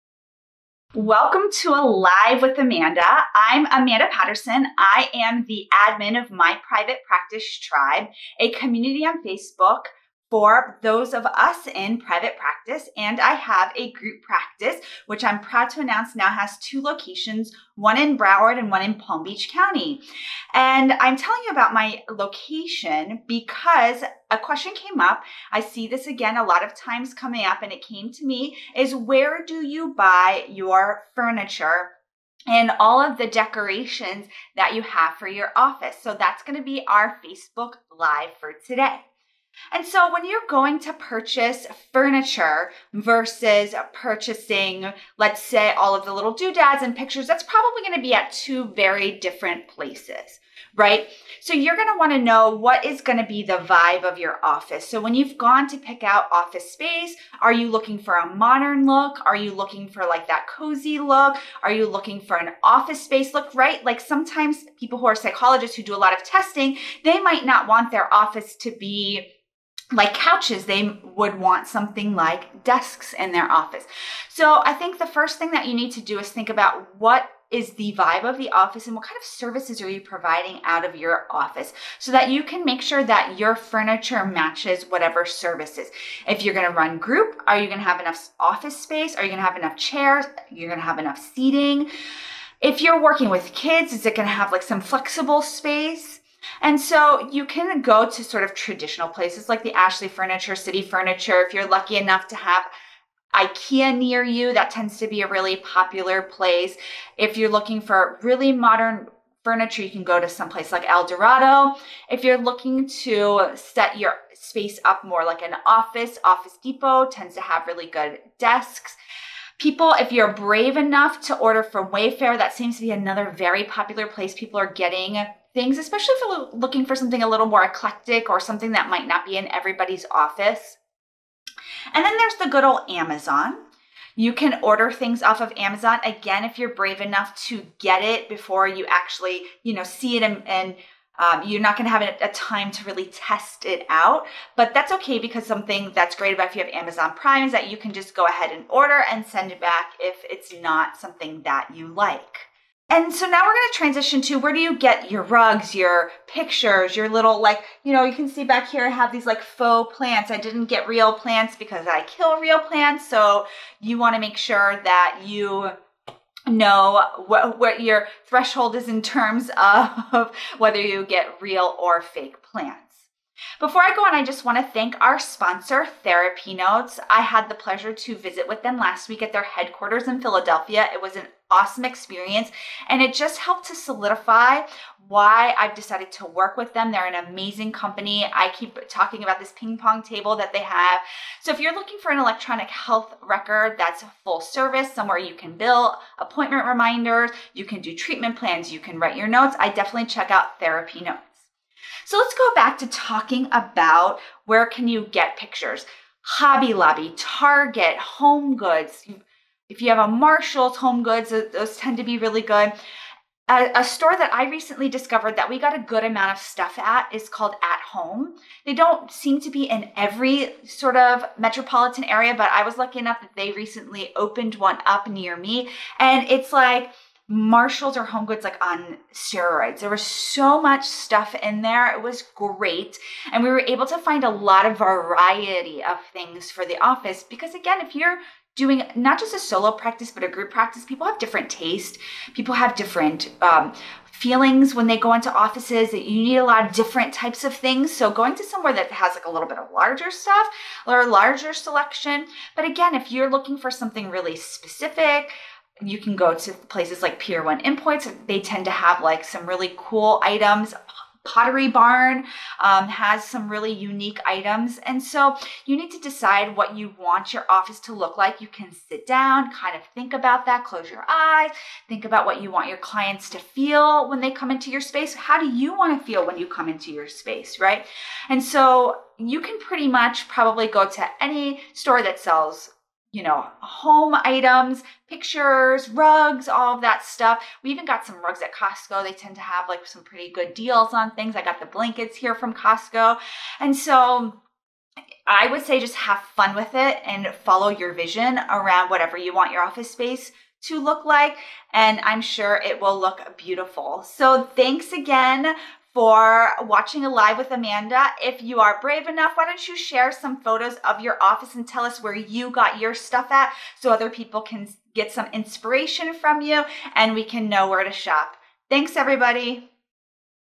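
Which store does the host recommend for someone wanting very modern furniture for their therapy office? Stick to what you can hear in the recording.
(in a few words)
El Dorado.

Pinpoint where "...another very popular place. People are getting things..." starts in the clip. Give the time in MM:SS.
02:02.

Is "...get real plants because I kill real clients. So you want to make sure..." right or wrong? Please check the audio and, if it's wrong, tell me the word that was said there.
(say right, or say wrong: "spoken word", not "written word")
wrong: "plants", not "clients".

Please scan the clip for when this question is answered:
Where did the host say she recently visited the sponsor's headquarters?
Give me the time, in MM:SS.
03:00.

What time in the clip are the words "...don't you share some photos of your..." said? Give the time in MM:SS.
05:09.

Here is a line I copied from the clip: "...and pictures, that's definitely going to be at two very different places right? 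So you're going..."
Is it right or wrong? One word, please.
wrong.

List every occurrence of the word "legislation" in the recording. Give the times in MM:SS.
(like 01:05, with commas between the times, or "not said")
not said.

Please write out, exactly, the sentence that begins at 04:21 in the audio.
Pottery Barn um, has some really unique items.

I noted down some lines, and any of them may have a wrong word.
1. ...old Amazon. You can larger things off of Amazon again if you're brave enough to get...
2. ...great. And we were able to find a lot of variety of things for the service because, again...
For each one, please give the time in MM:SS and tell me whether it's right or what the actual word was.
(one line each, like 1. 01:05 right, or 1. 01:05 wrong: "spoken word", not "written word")
1. 02:12 wrong: "order", not "larger"
2. 03:52 wrong: "office", not "service".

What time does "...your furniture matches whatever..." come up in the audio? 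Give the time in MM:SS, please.
01:23.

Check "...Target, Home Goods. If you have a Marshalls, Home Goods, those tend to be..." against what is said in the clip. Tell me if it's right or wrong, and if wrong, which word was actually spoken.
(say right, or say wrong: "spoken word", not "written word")
right.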